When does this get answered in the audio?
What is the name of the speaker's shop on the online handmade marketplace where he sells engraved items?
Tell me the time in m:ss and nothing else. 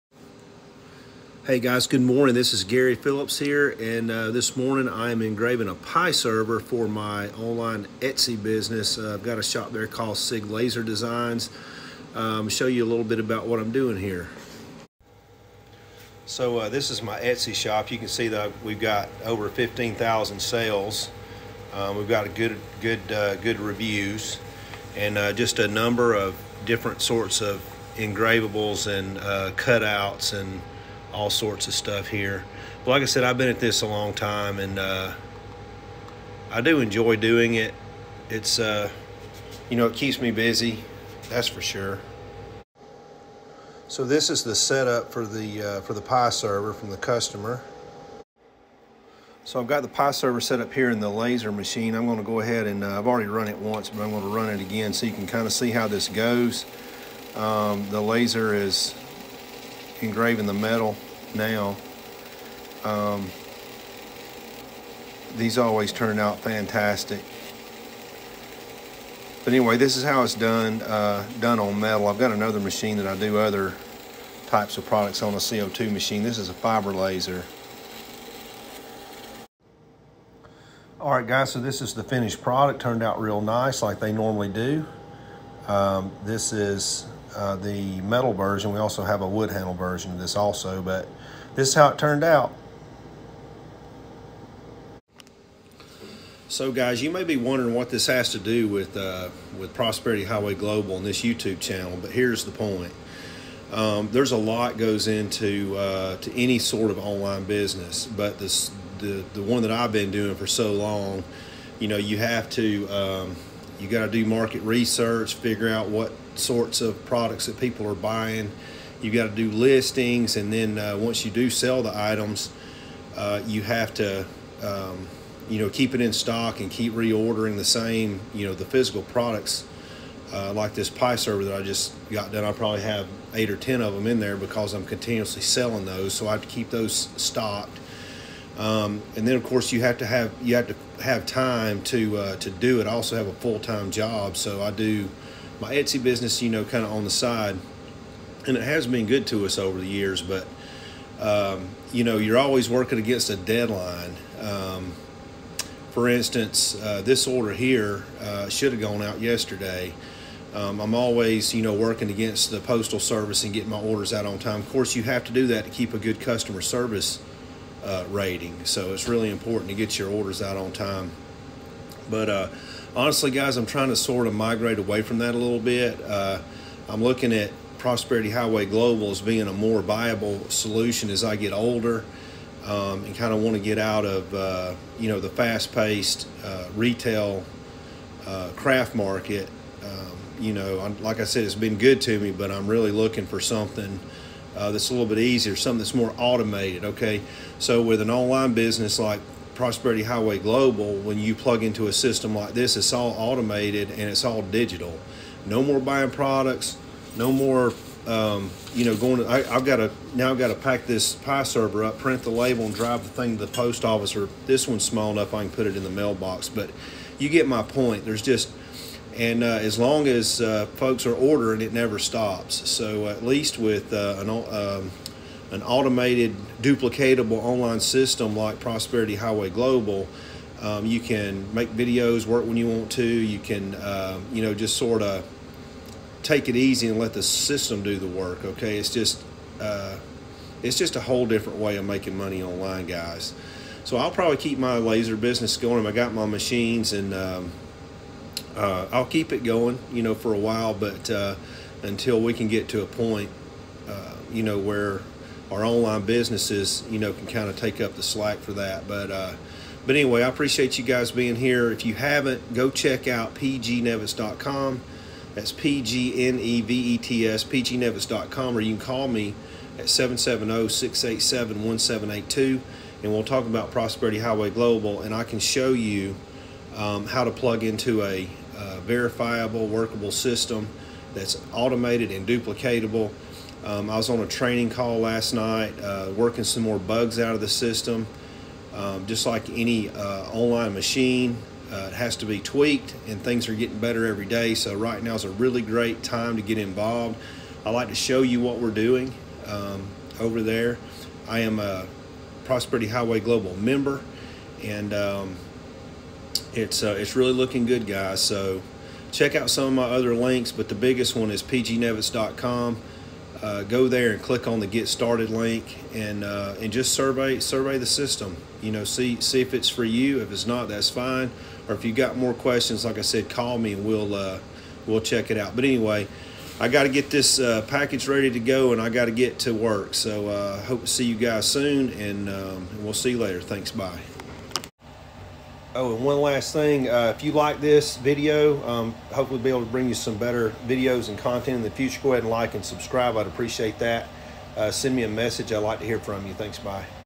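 0:10.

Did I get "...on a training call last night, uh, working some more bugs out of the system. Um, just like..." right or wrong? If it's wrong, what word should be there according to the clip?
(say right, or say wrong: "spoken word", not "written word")
right.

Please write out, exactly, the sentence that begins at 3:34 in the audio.
Or this one's small enough, I can put it in the mailbox.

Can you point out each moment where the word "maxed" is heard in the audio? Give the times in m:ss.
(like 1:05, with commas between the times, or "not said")
not said.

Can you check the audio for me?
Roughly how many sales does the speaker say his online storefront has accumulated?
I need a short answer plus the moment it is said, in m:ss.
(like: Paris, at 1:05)
over 15,000, at 0:19.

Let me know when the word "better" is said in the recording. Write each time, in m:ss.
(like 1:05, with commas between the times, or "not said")
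4:53, 5:40.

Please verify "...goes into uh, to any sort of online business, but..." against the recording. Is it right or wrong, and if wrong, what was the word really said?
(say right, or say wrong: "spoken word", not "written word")
right.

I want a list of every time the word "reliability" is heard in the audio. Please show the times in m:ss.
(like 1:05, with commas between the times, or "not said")
not said.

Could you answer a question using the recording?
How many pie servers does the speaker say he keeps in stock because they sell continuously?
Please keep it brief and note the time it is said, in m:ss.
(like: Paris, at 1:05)
8 or 10, at 2:13.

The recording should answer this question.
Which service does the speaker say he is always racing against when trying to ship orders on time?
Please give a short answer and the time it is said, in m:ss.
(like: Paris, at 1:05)
the postal service, at 2:42.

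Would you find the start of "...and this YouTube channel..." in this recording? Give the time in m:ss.
1:40.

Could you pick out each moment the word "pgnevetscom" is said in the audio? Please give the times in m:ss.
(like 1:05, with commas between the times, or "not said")
4:23, 4:27, 5:11.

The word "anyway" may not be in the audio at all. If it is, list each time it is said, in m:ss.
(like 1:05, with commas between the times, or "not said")
1:09, 4:19, 5:25.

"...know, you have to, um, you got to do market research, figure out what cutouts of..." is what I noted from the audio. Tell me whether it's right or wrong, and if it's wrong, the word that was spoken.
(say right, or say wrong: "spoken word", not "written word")
wrong: "sorts", not "cutouts".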